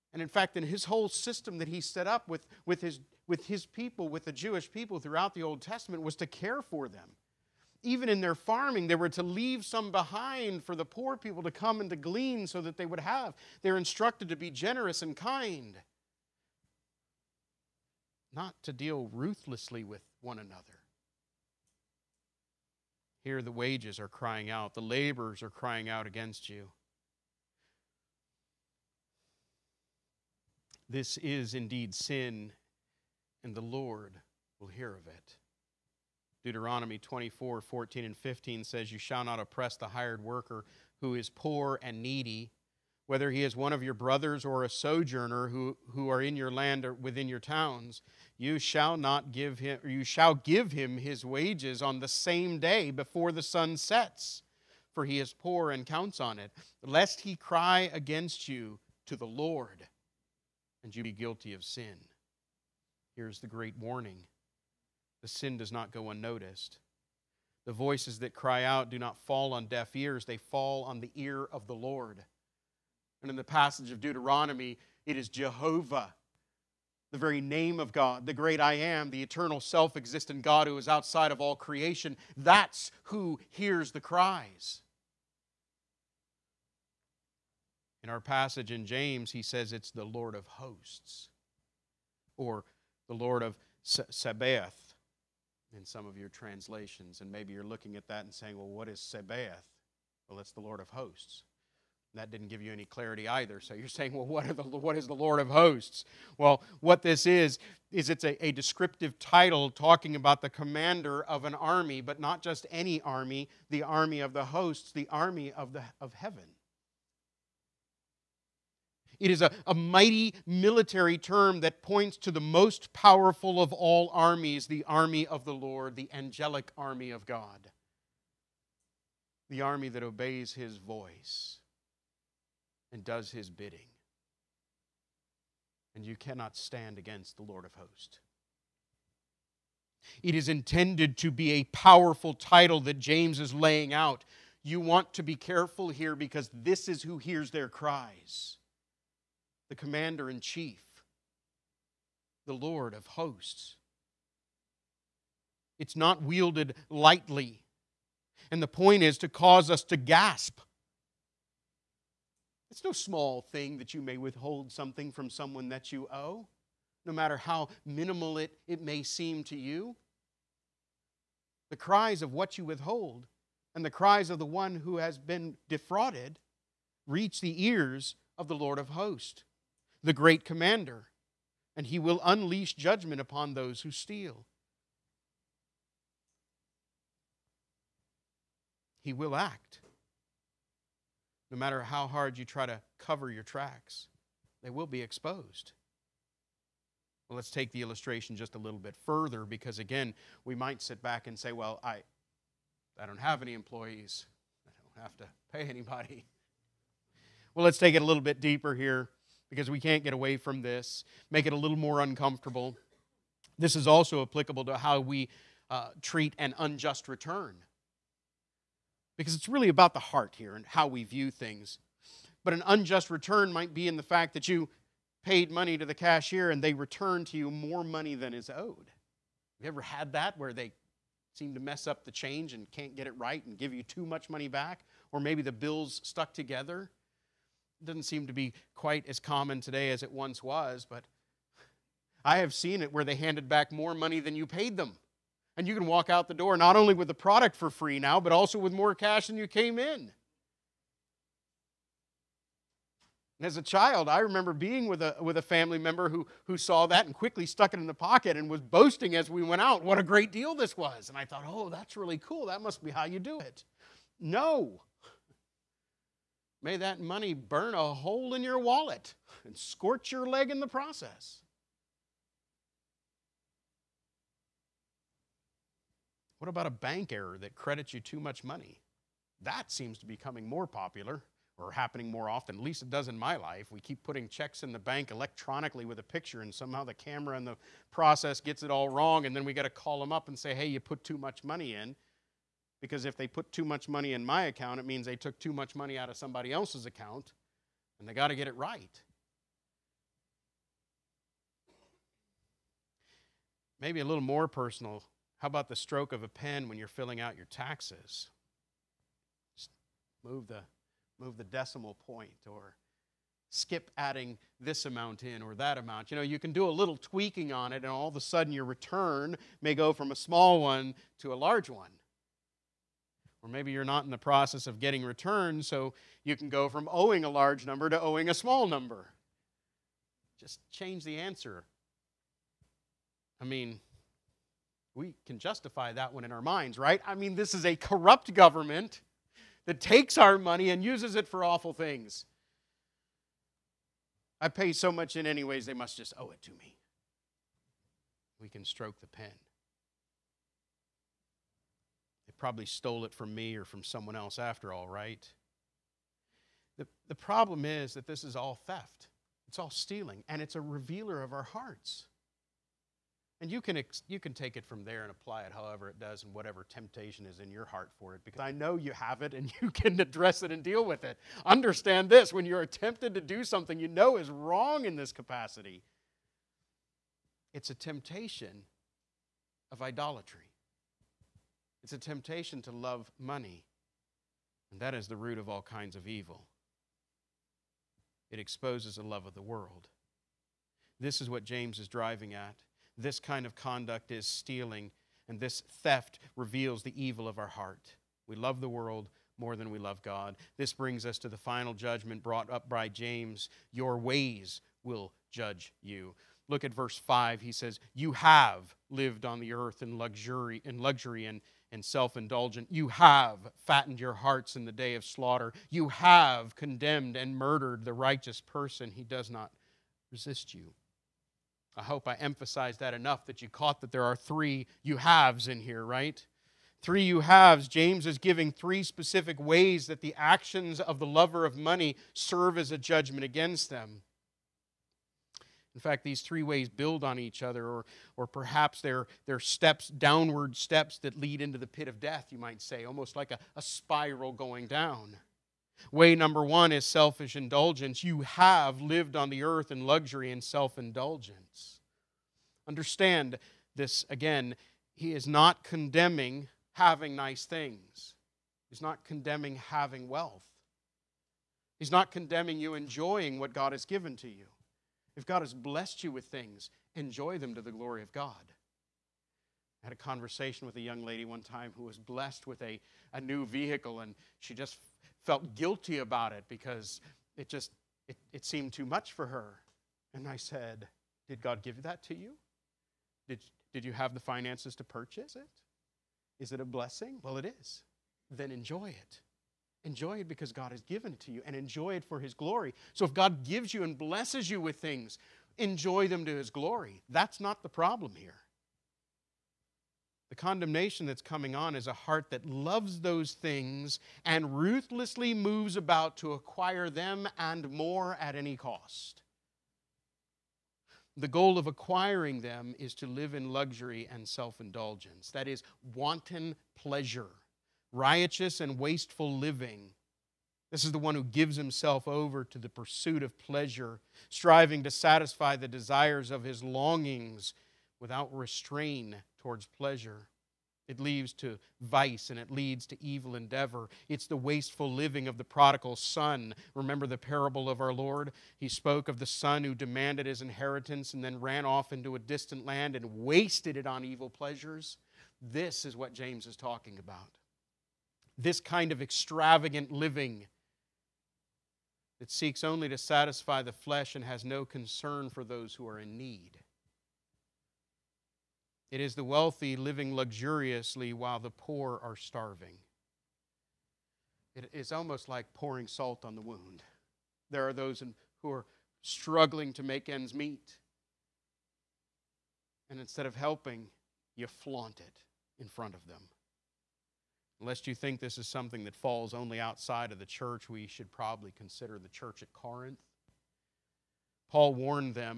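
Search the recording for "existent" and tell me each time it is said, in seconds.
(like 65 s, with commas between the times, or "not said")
79 s.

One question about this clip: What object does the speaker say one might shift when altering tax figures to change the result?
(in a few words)
the decimal point.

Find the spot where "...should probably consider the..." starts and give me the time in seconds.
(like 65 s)
580 s.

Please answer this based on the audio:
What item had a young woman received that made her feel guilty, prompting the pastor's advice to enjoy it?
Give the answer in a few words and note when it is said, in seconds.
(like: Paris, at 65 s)
a new vehicle, at 473 s.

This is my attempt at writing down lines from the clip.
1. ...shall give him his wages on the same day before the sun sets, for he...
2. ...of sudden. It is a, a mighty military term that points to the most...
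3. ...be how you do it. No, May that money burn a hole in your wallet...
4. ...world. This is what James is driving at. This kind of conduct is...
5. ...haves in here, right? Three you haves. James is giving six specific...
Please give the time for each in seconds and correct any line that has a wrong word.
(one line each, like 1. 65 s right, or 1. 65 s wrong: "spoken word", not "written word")
1. 50 s right
2. 116 s wrong: "heaven", not "sudden"
3. 262 s right
4. 389 s right
5. 424 s wrong: "three", not "six".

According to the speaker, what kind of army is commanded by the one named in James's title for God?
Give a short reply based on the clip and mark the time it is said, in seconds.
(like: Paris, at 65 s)
angelic army, at 126 s.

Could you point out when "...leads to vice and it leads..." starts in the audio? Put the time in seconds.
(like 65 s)
530 s.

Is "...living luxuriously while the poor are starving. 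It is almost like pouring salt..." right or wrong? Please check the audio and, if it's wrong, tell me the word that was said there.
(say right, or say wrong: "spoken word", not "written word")
right.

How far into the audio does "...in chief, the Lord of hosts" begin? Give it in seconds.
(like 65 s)
150 s.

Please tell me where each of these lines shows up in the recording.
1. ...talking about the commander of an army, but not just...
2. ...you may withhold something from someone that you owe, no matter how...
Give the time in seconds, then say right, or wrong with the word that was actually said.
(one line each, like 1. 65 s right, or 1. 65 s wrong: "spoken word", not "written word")
1. 109 s right
2. 163 s right.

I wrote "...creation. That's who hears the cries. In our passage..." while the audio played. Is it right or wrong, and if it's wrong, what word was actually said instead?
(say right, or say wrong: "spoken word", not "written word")
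right.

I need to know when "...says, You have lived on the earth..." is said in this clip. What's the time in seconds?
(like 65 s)
407 s.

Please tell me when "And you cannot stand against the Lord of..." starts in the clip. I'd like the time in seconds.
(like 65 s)
135 s.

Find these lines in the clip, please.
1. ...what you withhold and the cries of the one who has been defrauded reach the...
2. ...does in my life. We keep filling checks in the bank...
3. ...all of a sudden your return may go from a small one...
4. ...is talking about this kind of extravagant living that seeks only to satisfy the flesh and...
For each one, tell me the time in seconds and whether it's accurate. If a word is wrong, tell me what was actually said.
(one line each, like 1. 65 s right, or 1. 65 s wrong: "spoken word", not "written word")
1. 172 s right
2. 282 s wrong: "putting", not "filling"
3. 317 s right
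4. 546 s right.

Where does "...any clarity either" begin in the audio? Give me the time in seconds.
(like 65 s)
102 s.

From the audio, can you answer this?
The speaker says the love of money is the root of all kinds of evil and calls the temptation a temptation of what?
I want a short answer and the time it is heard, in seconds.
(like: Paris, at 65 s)
idolatry, at 379 s.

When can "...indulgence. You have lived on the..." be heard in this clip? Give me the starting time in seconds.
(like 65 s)
447 s.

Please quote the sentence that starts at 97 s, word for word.
And maybe you're looking at that and saying, well, what is Sabaoth?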